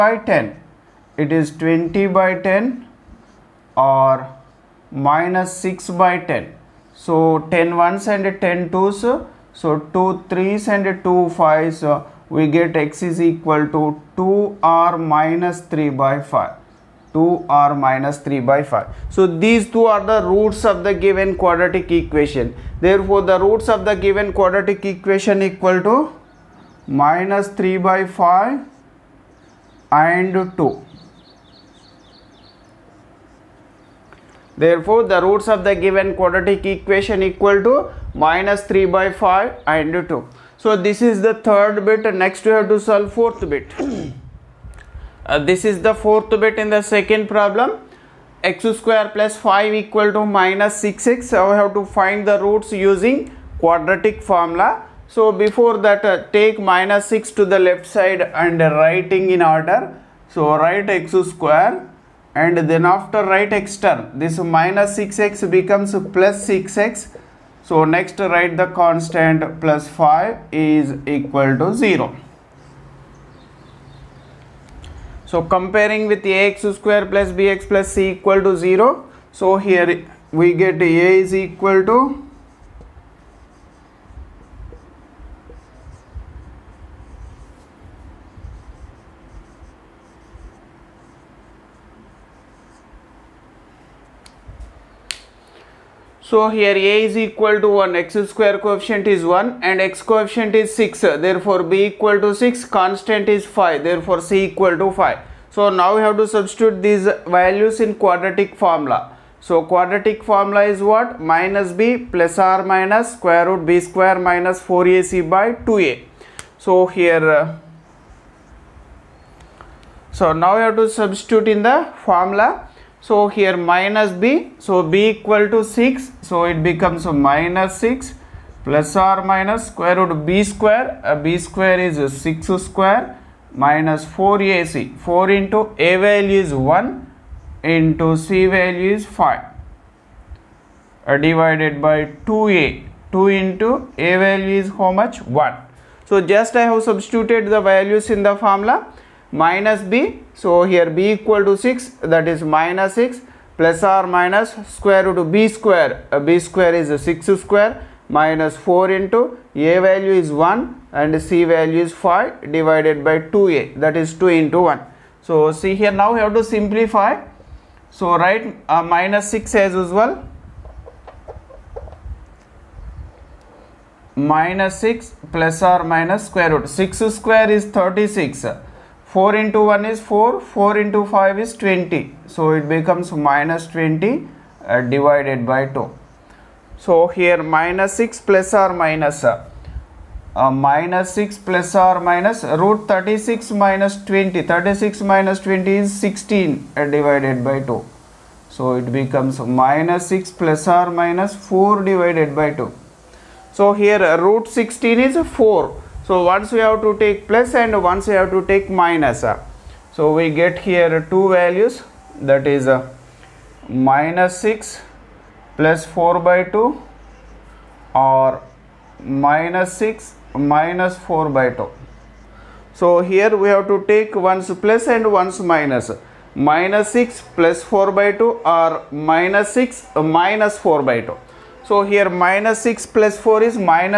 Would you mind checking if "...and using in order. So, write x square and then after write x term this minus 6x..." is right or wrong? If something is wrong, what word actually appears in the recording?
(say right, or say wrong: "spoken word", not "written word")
wrong: "writing", not "using".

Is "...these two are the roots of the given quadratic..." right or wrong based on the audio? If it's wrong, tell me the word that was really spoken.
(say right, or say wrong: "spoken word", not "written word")
right.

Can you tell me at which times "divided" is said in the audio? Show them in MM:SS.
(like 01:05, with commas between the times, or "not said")
02:21, 02:42, 03:04, 03:16, 03:21.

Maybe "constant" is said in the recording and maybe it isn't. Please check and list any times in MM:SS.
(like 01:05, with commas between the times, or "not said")
01:08, 01:42.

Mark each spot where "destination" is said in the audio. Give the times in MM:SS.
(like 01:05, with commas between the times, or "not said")
not said.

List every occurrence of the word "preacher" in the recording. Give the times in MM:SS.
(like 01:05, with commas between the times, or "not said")
not said.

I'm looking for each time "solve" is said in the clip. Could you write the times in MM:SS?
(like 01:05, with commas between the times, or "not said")
00:42.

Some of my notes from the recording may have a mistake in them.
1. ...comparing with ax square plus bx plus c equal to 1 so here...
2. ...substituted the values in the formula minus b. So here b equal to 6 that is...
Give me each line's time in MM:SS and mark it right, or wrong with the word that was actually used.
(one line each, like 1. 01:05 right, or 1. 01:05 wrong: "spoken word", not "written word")
1. 01:15 wrong: "0", not "1"
2. 02:26 right.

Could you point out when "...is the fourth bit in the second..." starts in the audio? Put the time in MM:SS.
00:45.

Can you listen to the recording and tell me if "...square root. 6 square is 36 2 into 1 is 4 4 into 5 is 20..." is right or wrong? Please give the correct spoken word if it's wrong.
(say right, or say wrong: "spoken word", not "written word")
wrong: "4", not "2".